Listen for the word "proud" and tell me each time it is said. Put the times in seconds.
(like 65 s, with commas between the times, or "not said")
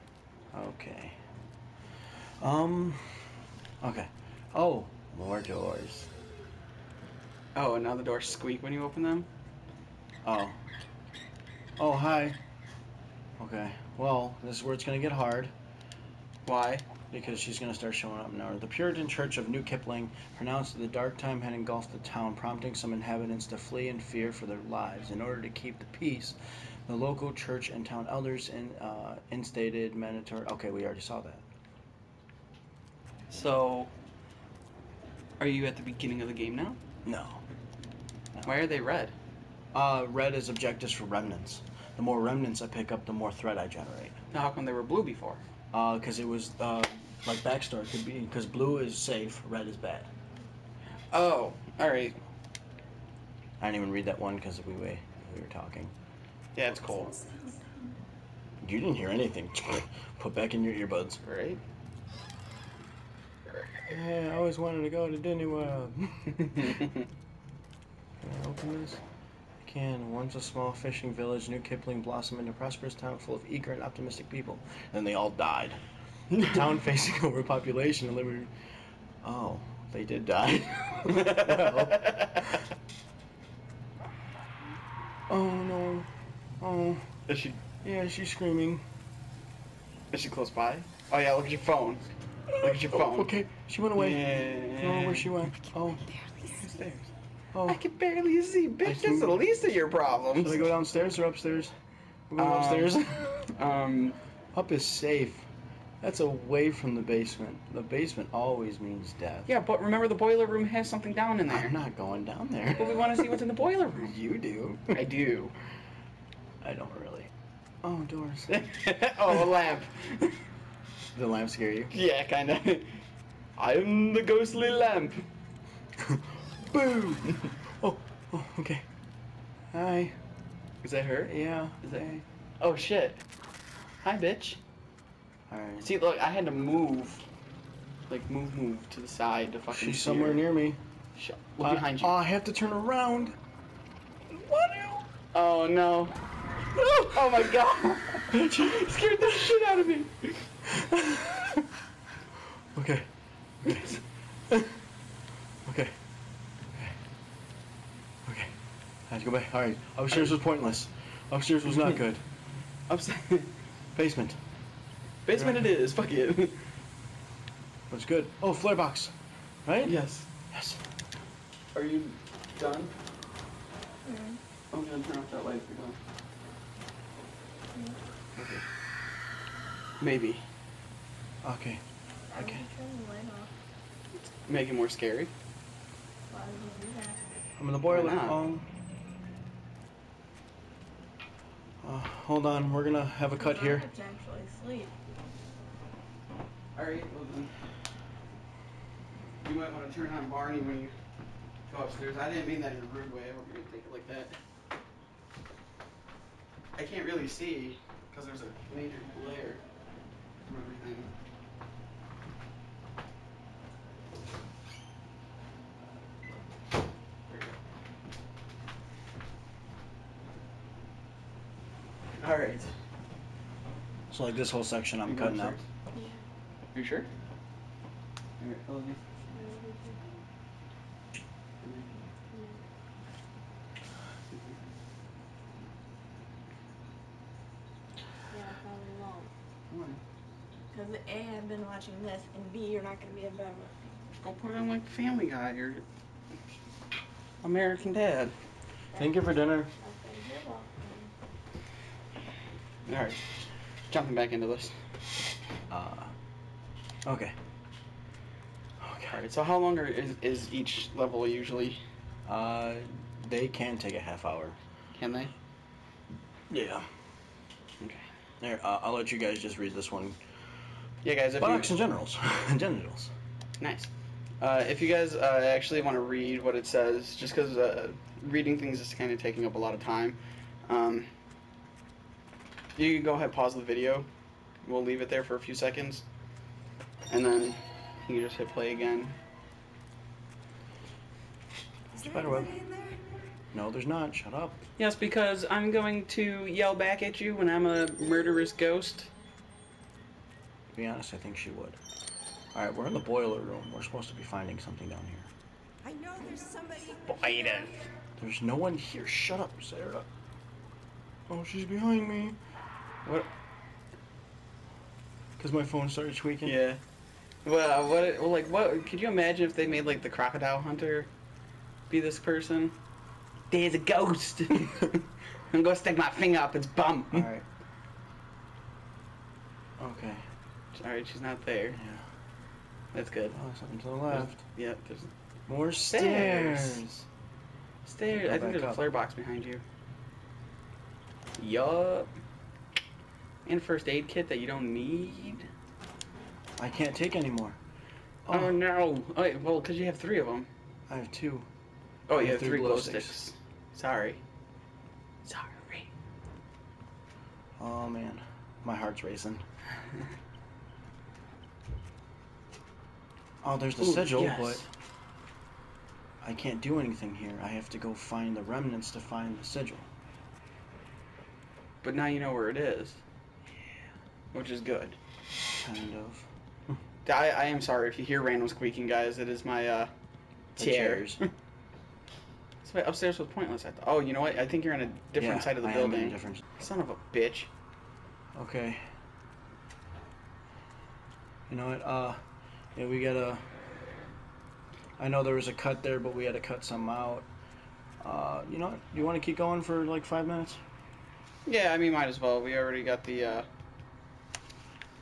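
not said.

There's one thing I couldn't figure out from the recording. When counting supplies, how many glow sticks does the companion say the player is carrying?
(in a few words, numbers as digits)
3.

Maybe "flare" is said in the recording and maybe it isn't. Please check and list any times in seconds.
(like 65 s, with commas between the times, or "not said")
168 s, 338 s.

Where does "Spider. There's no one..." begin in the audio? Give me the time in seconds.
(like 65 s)
307 s.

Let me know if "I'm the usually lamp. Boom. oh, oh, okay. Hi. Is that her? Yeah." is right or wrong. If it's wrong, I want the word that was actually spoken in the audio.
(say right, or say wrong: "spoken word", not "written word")
wrong: "ghostly", not "usually".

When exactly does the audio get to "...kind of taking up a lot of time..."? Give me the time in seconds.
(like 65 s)
278 s.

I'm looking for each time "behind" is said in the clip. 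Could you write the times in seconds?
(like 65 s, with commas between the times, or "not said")
141 s, 311 s, 339 s.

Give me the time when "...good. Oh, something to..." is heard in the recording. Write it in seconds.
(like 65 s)
333 s.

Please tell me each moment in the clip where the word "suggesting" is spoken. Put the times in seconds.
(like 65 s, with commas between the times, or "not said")
not said.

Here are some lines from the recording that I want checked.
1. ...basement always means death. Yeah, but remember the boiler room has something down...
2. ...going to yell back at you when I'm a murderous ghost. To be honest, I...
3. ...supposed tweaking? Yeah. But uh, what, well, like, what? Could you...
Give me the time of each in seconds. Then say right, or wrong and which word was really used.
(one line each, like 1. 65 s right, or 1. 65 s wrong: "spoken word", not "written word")
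1. 107 s right
2. 295 s right
3. 315 s wrong: "started", not "supposed".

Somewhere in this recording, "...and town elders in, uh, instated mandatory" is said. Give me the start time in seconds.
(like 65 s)
27 s.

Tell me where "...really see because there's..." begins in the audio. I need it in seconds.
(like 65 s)
207 s.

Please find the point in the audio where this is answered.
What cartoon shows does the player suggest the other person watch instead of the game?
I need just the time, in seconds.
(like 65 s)
244 s.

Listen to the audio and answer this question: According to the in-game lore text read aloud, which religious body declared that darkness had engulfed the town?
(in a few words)
Puritan Church of New Kipling.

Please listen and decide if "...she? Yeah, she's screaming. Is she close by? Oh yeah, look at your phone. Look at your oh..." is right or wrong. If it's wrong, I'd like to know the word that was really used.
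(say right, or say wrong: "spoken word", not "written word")
right.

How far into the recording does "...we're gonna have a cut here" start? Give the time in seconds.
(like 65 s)
192 s.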